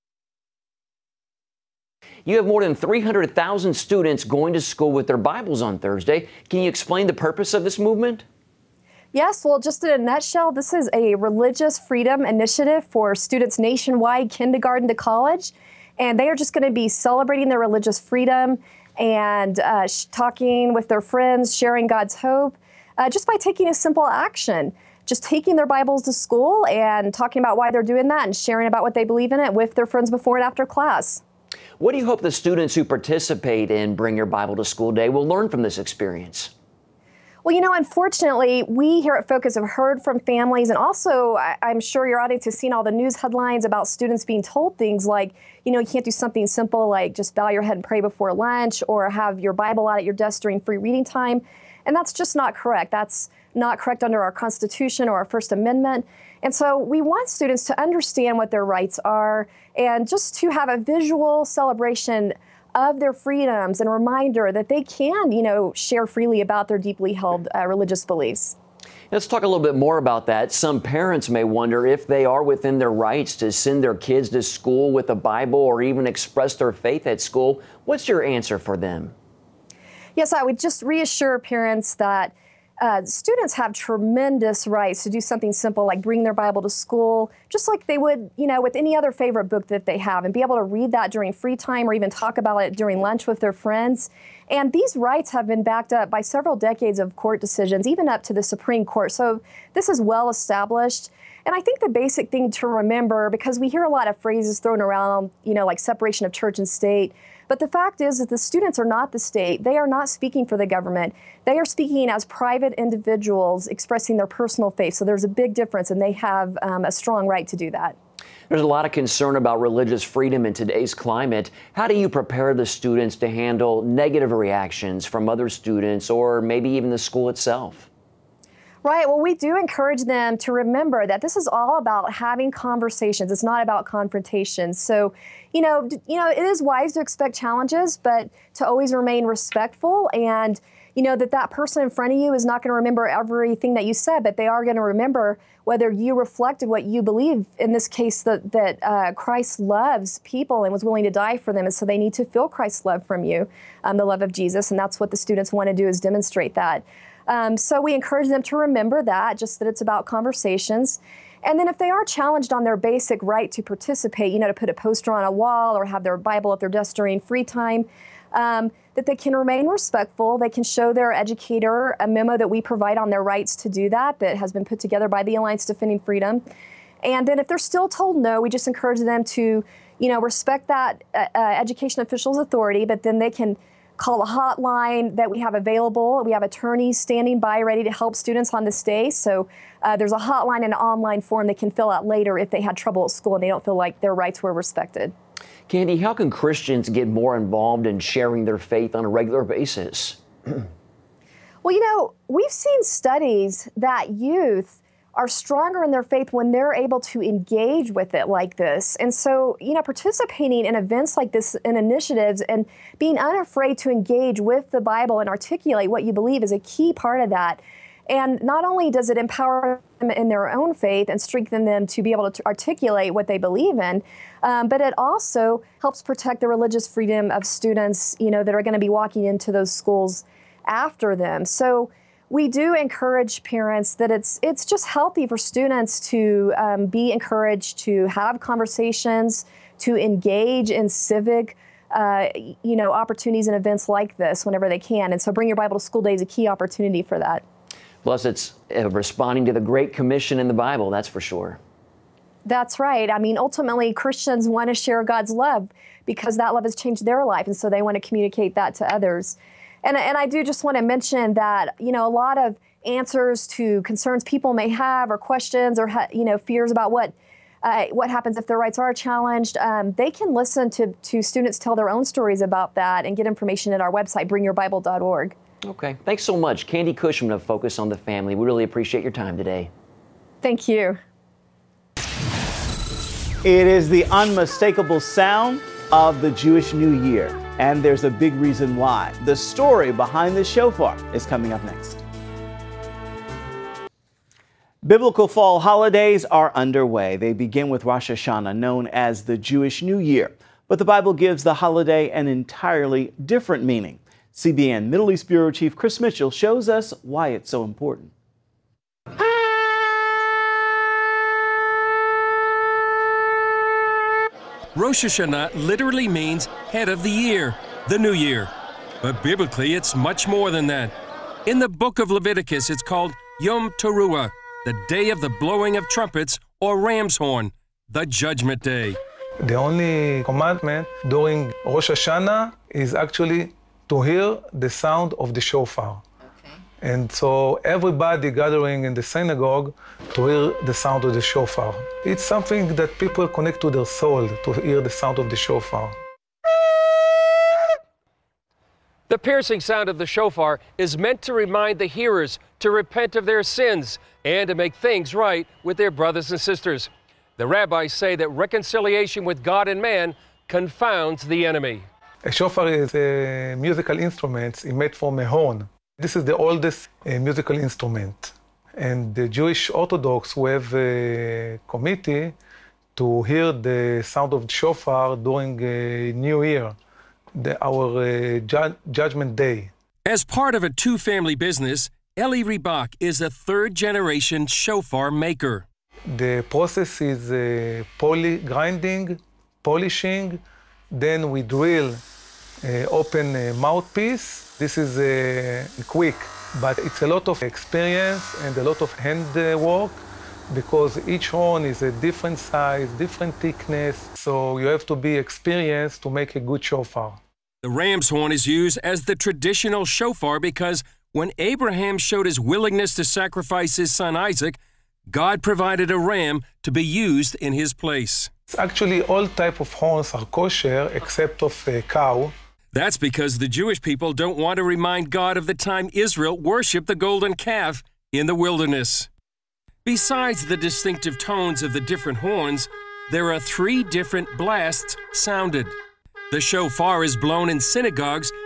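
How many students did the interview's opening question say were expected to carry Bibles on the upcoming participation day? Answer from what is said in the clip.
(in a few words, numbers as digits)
300,000.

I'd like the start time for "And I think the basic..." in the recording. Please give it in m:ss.
1:41.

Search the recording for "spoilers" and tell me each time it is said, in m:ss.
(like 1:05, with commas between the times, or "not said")
not said.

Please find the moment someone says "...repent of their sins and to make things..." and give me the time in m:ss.
5:52.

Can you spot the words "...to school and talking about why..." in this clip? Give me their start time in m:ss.
0:26.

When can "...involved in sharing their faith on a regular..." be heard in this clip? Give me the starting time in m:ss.
3:17.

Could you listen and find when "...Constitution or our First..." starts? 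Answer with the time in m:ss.
0:54.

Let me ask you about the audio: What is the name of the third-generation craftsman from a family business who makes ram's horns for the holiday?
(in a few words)
Eli Rebach.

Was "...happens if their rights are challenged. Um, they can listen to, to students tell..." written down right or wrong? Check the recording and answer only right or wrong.
right.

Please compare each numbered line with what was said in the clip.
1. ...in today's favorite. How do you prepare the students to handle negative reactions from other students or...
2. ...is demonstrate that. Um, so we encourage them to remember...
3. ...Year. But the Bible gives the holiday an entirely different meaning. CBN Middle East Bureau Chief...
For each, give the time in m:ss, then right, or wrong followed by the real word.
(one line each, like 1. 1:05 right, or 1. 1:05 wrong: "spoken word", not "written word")
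1. 2:00 wrong: "climate", not "favorite"
2. 2:35 right
3. 4:59 right.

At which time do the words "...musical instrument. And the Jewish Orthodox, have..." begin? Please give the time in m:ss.
6:07.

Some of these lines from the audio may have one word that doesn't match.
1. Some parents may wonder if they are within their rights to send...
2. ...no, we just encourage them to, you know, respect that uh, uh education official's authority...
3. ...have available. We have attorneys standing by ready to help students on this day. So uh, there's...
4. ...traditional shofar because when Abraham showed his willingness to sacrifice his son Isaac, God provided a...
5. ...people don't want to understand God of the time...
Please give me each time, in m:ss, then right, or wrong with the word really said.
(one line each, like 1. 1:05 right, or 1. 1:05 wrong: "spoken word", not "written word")
1. 1:10 right
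2. 2:58 right
3. 3:05 right
4. 6:49 right
5. 7:03 wrong: "remind", not "understand".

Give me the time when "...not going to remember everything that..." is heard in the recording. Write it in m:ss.
2:22.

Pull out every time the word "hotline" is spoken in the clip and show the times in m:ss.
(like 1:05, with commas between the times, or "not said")
3:04, 3:10.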